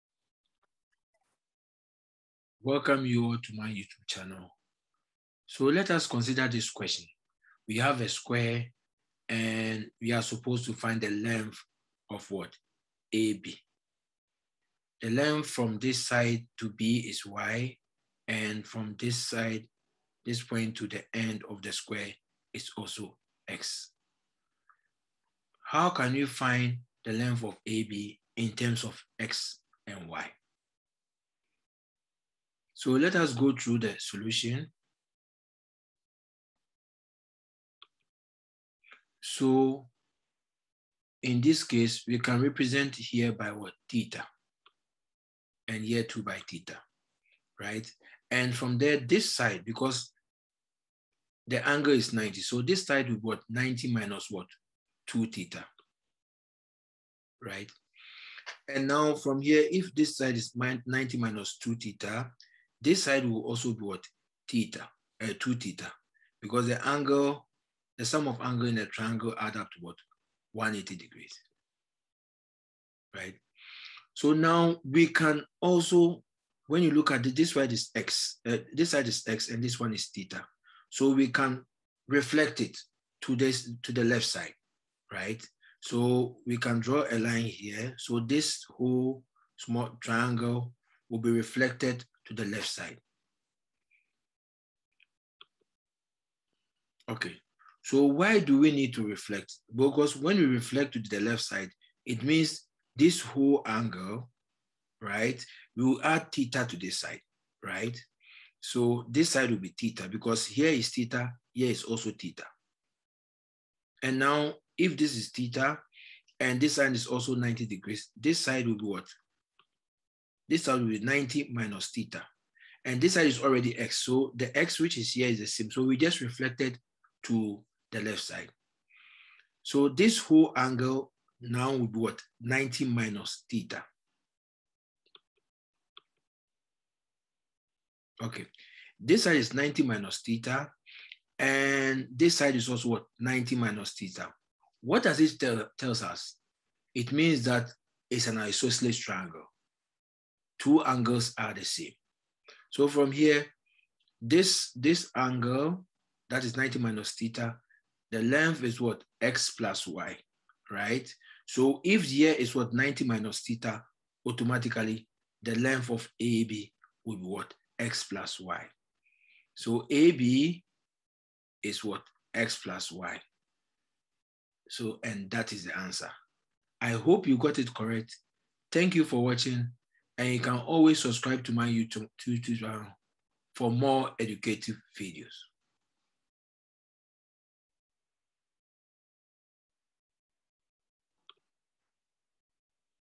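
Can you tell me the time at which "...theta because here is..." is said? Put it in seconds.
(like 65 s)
109 s.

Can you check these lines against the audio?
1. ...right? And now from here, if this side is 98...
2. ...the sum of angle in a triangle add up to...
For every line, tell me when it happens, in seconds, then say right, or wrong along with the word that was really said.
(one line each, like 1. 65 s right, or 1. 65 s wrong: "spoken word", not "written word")
1. 57 s wrong: "90", not "98"
2. 67 s right.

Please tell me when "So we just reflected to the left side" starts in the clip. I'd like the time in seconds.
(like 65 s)
125 s.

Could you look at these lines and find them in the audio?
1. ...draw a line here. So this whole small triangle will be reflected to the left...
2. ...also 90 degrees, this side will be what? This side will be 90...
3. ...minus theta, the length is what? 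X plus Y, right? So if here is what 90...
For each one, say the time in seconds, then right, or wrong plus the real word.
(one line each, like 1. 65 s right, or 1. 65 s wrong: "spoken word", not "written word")
1. 86 s right
2. 117 s right
3. 156 s right.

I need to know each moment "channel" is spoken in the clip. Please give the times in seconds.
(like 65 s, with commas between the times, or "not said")
4 s, 182 s.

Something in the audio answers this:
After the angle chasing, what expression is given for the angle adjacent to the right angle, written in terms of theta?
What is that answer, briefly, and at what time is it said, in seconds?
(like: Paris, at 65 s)
90 minus 2 theta, at 53 s.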